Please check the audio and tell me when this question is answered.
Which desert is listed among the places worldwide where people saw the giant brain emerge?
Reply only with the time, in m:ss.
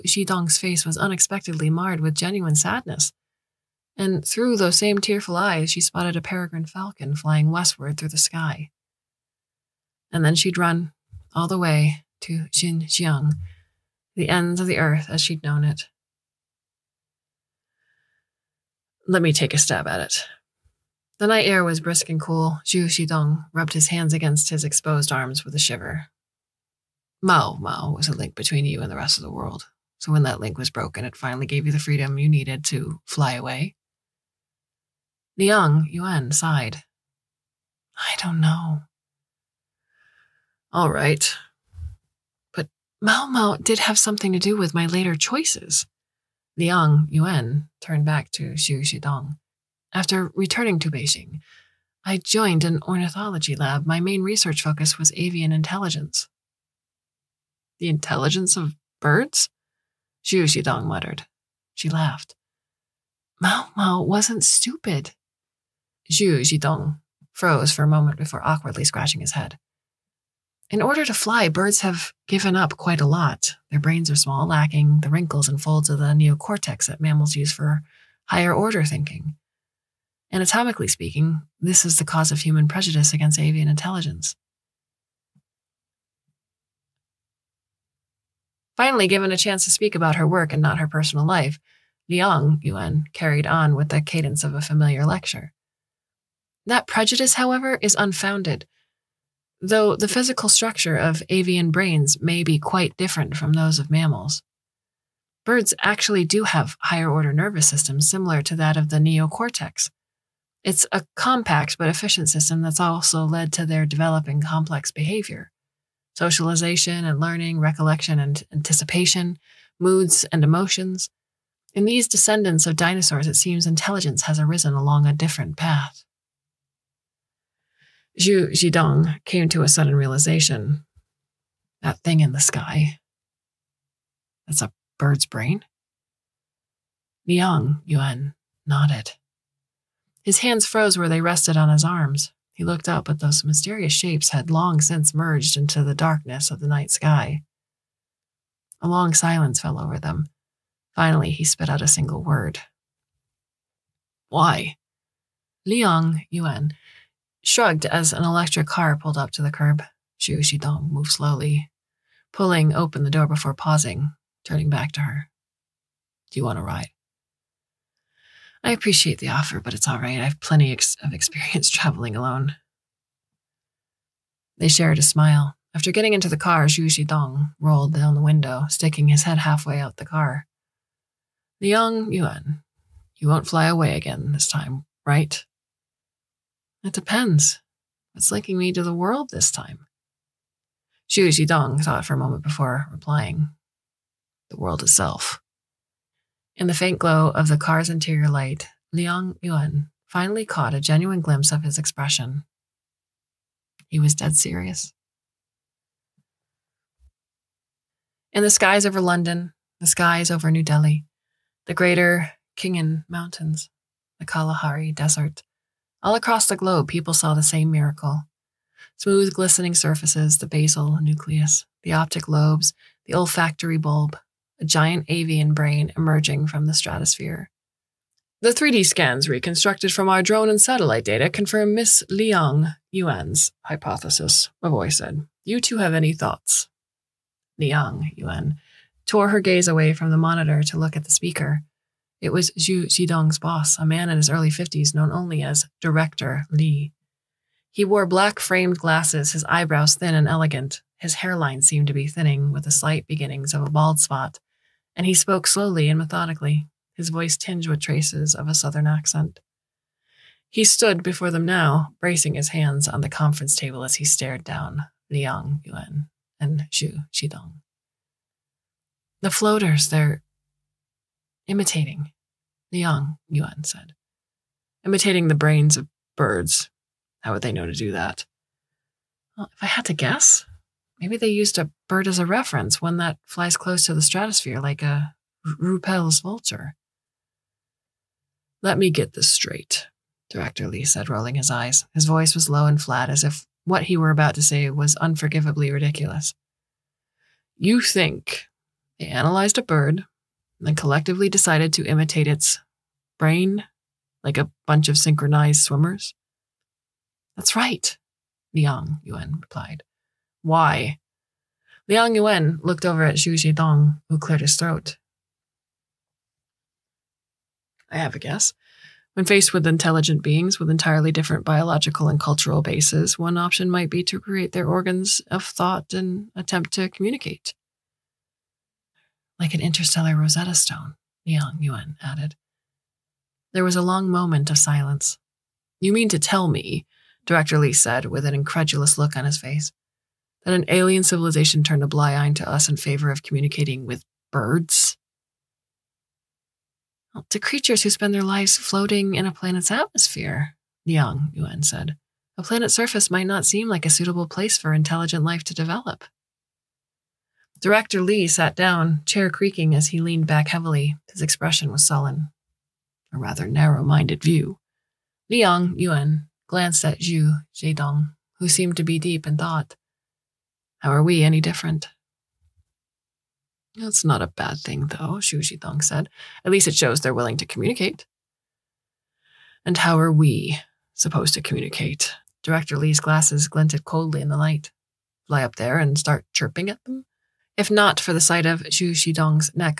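3:34.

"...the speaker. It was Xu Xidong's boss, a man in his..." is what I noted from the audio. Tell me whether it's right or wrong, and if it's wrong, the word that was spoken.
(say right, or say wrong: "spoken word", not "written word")
right.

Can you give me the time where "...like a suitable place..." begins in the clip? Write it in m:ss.
5:53.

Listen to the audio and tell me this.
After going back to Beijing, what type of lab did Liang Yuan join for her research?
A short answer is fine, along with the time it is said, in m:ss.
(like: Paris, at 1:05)
Ornithology lab, at 0:52.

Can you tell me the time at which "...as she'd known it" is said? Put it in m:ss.
0:15.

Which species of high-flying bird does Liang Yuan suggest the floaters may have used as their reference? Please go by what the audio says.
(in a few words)
Rüppell's vulture.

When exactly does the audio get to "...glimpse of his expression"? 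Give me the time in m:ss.
3:21.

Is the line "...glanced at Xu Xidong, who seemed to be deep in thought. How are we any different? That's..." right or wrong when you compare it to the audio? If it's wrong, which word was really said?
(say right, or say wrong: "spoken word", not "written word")
right.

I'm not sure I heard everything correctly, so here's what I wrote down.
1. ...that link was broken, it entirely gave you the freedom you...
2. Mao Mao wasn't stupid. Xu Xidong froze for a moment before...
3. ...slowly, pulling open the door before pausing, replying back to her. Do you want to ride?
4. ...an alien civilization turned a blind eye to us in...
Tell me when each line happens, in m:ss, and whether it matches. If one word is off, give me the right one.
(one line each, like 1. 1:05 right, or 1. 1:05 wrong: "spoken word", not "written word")
1. 0:30 wrong: "finally", not "entirely"
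2. 1:03 right
3. 2:41 wrong: "turning", not "replying"
4. 5:40 right.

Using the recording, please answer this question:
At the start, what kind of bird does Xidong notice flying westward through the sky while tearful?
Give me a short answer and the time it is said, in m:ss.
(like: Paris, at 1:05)
Peregrine falcon, at 0:06.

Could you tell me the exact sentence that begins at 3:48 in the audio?
The 3D scans reconstructed from our drone and satellite data confirm Miss Liang Yuan's hypothesis, voice said.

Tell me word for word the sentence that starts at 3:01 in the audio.
Liang Yuan, you won't fly away again this time, right?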